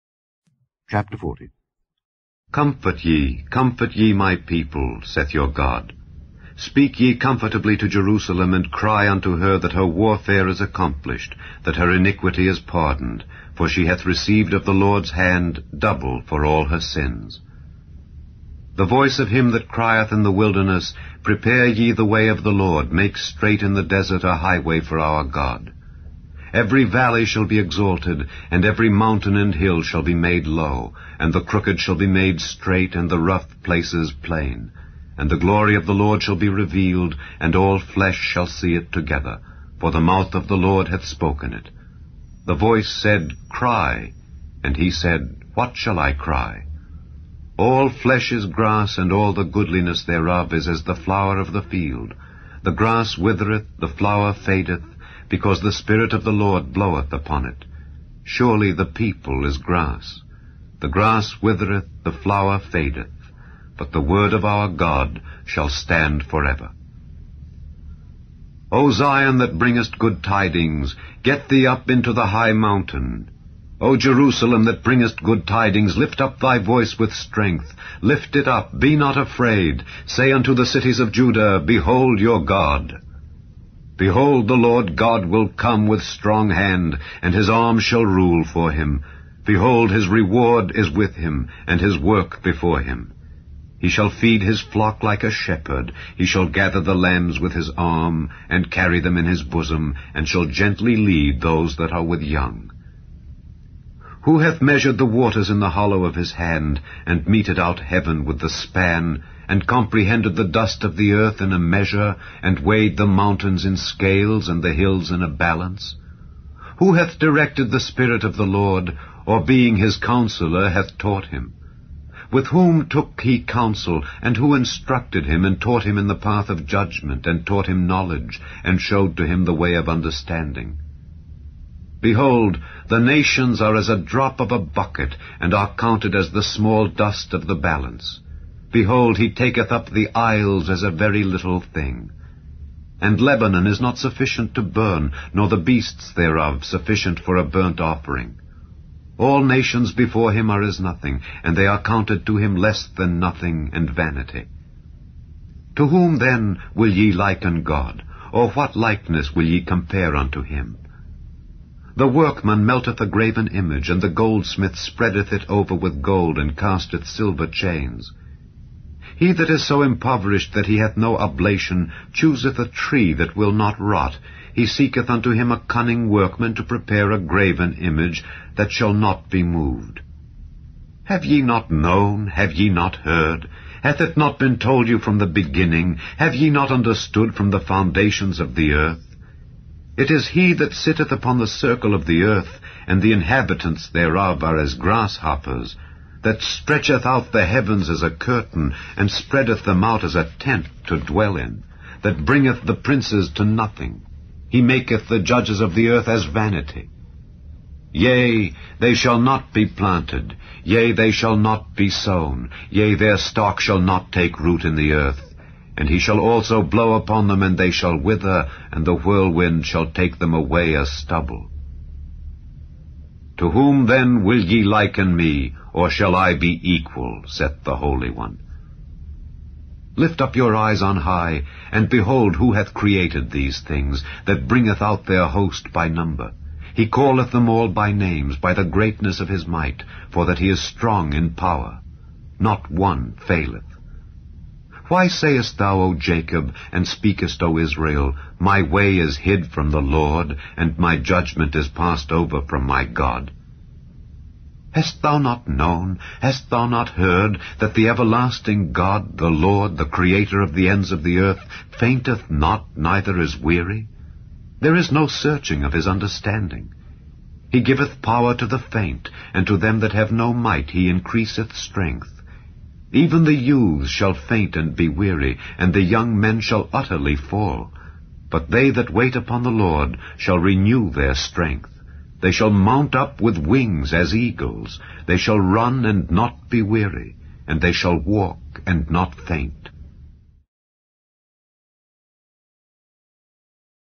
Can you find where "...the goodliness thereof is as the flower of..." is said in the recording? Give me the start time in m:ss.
0:49.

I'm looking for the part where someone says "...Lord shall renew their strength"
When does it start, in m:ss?
4:39.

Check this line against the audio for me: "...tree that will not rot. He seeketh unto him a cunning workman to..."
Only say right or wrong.
right.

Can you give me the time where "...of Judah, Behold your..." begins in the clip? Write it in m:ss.
1:20.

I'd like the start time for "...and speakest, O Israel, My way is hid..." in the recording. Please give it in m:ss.
4:06.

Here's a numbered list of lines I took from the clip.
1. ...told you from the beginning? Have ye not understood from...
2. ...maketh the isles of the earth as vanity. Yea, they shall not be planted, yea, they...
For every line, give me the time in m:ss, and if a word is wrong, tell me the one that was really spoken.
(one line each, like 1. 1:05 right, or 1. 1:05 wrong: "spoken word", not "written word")
1. 3:04 right
2. 3:24 wrong: "judges", not "isles".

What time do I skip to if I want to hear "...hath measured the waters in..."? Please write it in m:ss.
1:44.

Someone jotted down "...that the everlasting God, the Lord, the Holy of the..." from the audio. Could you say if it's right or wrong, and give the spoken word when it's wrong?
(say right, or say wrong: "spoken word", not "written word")
wrong: "Creator", not "Holy".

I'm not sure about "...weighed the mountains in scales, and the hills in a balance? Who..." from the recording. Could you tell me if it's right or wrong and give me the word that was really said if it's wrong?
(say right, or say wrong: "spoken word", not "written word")
right.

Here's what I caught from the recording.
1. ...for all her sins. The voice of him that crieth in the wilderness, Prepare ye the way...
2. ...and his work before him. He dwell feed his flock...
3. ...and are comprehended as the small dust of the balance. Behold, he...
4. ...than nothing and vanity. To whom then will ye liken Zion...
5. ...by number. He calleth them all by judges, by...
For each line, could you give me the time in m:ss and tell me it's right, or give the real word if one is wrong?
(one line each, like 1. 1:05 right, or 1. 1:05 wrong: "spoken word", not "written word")
1. 0:16 right
2. 1:31 wrong: "shall", not "dwell"
3. 2:15 wrong: "counted", not "comprehended"
4. 2:32 wrong: "God", not "Zion"
5. 3:55 wrong: "names", not "judges".